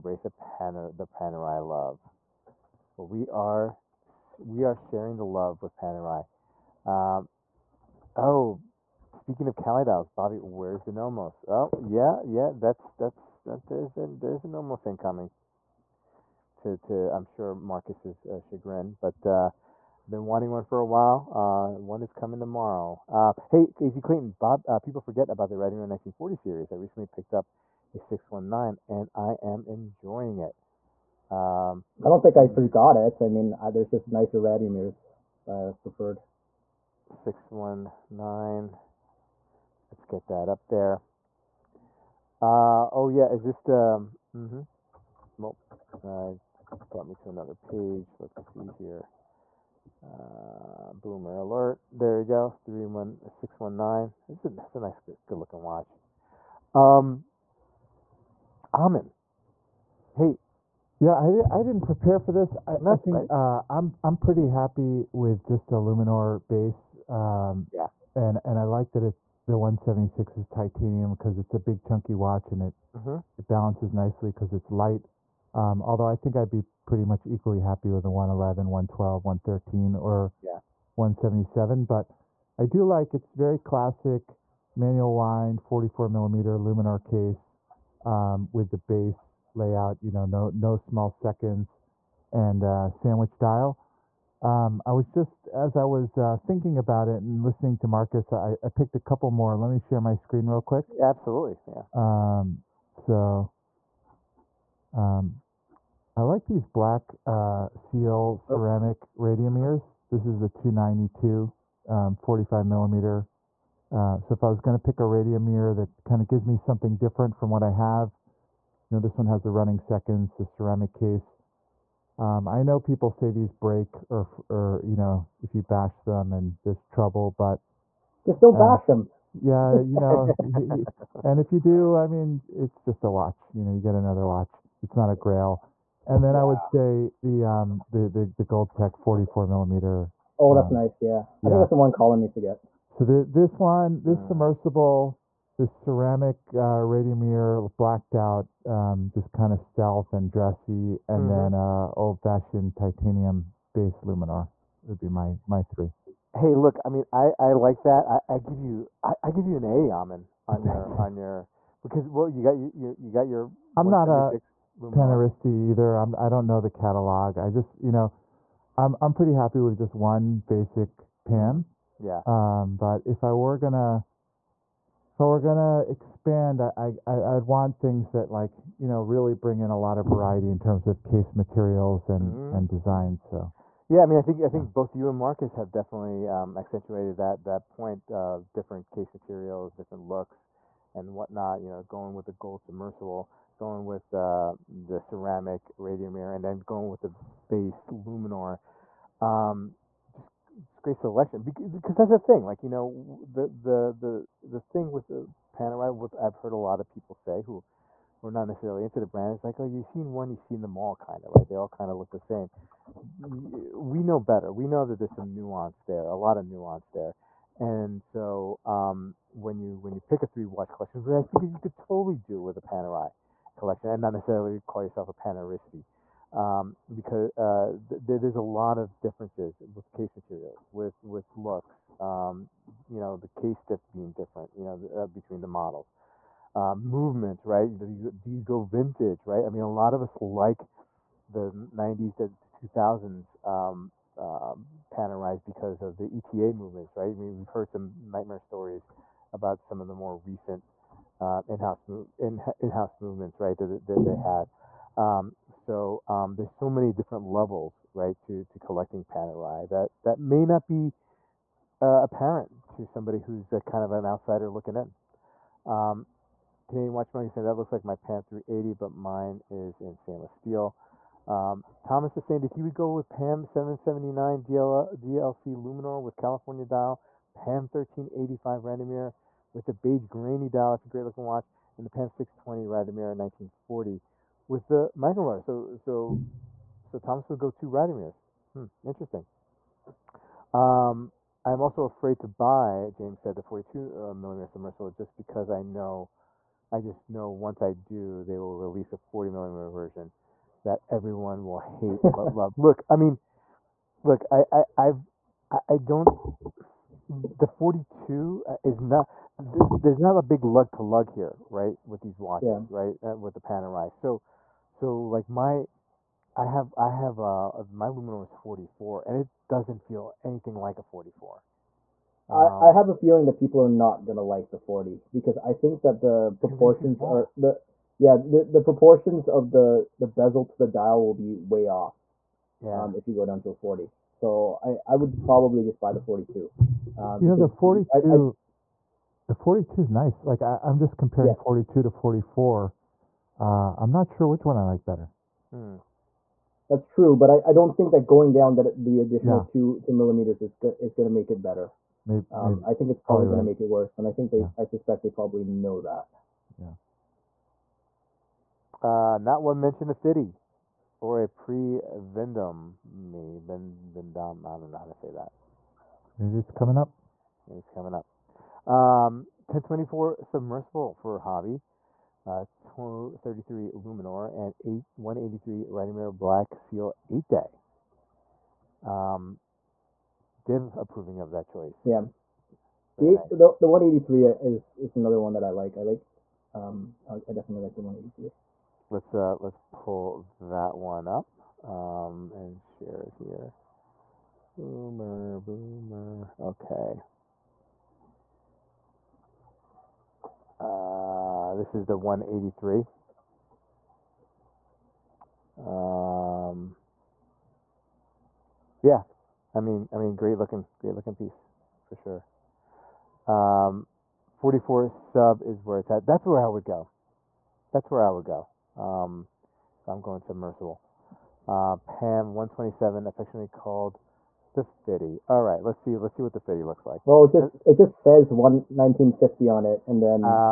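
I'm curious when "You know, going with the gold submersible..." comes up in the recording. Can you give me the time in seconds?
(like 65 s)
191 s.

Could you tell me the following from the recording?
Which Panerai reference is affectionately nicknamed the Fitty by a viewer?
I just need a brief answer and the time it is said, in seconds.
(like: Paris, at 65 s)
Pam 127, at 421 s.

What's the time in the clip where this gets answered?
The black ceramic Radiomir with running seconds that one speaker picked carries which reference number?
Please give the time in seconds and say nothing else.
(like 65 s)
110 s.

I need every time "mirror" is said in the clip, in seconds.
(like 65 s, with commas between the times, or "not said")
146 s.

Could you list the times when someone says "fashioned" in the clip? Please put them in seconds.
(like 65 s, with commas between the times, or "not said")
152 s.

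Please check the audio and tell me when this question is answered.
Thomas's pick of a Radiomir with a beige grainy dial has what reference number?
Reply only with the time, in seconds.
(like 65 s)
277 s.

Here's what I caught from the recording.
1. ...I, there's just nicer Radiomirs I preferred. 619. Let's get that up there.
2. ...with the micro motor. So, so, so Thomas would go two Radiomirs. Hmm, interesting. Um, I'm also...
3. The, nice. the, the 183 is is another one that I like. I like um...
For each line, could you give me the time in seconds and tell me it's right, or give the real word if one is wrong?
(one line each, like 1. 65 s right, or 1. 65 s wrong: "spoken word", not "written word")
1. 33 s right
2. 284 s right
3. 382 s right.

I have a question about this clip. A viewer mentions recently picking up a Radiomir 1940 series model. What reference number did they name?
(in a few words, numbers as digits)
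619.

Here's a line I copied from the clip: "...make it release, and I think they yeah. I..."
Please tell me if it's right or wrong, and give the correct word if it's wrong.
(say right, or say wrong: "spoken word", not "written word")
wrong: "worse", not "release".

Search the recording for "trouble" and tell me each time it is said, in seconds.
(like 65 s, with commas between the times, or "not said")
126 s.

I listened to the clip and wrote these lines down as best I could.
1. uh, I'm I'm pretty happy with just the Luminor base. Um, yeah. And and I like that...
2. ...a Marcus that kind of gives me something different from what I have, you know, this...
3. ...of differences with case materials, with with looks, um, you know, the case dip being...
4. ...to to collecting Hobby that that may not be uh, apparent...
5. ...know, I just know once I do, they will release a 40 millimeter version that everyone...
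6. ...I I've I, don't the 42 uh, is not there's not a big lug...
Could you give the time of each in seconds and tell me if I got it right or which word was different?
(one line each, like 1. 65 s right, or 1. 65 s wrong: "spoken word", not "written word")
1. 63 s right
2. 114 s wrong: "Radiomir", not "Marcus"
3. 228 s right
4. 258 s wrong: "Panerai", not "Hobby"
5. 295 s right
6. 304 s right.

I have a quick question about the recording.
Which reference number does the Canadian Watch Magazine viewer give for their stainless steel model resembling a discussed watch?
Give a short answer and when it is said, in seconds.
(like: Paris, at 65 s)
380, at 267 s.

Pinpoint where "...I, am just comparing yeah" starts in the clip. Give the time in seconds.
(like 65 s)
340 s.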